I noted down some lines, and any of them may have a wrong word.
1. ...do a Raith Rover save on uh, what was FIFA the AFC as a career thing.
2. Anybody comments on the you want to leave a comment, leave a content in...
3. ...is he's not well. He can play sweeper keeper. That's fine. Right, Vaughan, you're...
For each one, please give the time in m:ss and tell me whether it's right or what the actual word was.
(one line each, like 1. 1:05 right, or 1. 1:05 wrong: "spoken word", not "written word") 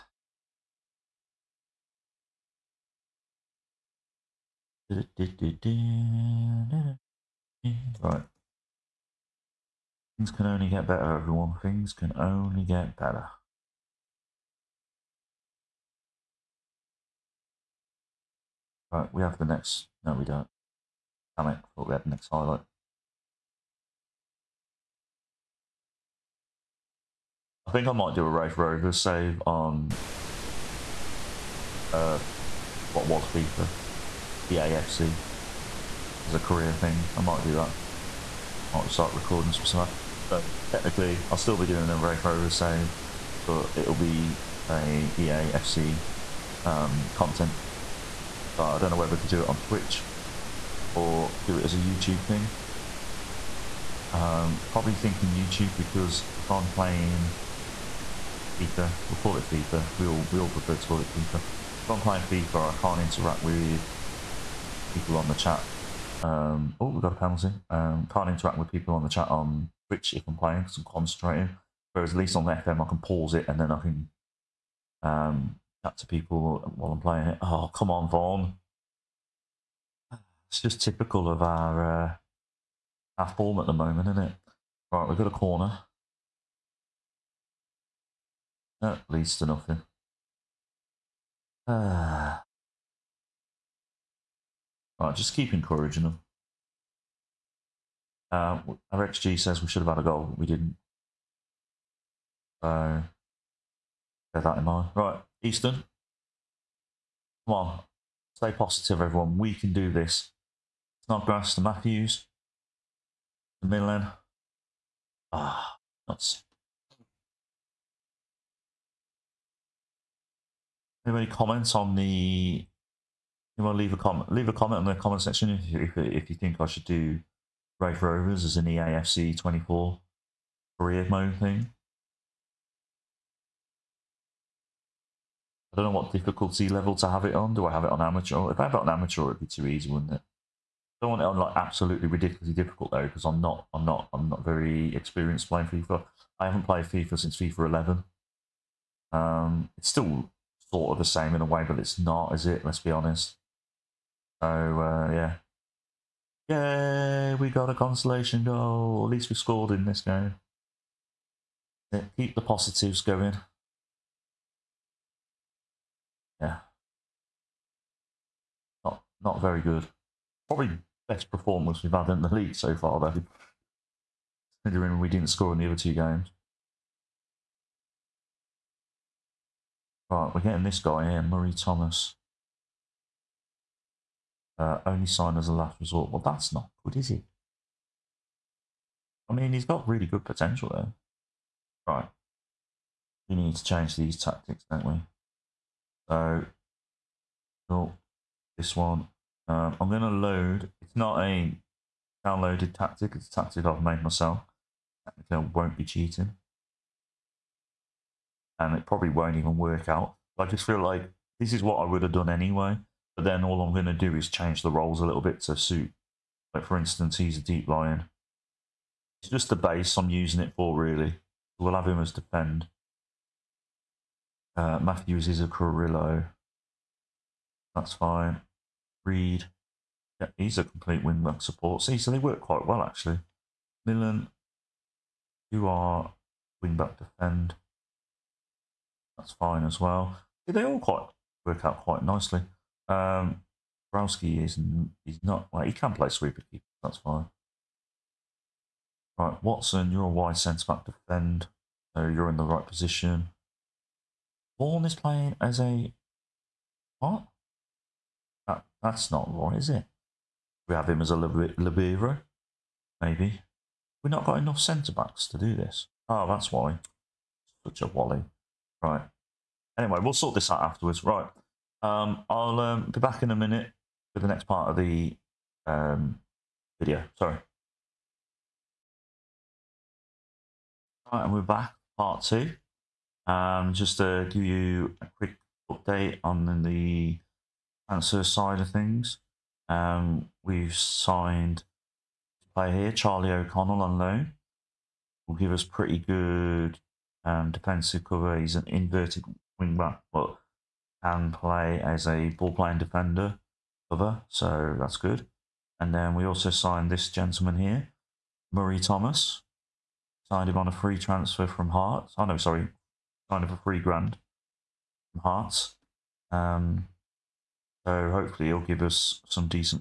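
1. 0:28 right
2. 2:01 wrong: "comment", not "content"
3. 4:04 wrong: "Watson", not "Vaughan".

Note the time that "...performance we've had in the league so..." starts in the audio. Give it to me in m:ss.
2:51.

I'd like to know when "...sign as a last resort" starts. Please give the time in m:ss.
3:05.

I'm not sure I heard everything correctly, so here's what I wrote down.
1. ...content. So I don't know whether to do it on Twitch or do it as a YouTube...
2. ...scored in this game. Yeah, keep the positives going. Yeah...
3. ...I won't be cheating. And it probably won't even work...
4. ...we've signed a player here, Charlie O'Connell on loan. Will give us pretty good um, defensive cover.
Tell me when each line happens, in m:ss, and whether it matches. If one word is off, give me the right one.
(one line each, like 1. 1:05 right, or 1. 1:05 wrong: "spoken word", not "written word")
1. 0:47 right
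2. 2:39 right
3. 3:25 right
4. 4:50 right.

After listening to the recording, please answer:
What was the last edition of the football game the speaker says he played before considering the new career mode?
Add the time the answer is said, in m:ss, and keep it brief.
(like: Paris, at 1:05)
FIFA 11, at 2:27.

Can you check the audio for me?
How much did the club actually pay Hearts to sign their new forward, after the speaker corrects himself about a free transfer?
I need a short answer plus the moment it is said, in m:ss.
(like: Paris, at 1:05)
three grand, at 5:13.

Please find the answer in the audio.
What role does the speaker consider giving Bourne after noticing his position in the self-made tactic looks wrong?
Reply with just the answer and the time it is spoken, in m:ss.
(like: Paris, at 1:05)
libero, at 4:21.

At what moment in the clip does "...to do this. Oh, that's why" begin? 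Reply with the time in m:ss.
4:25.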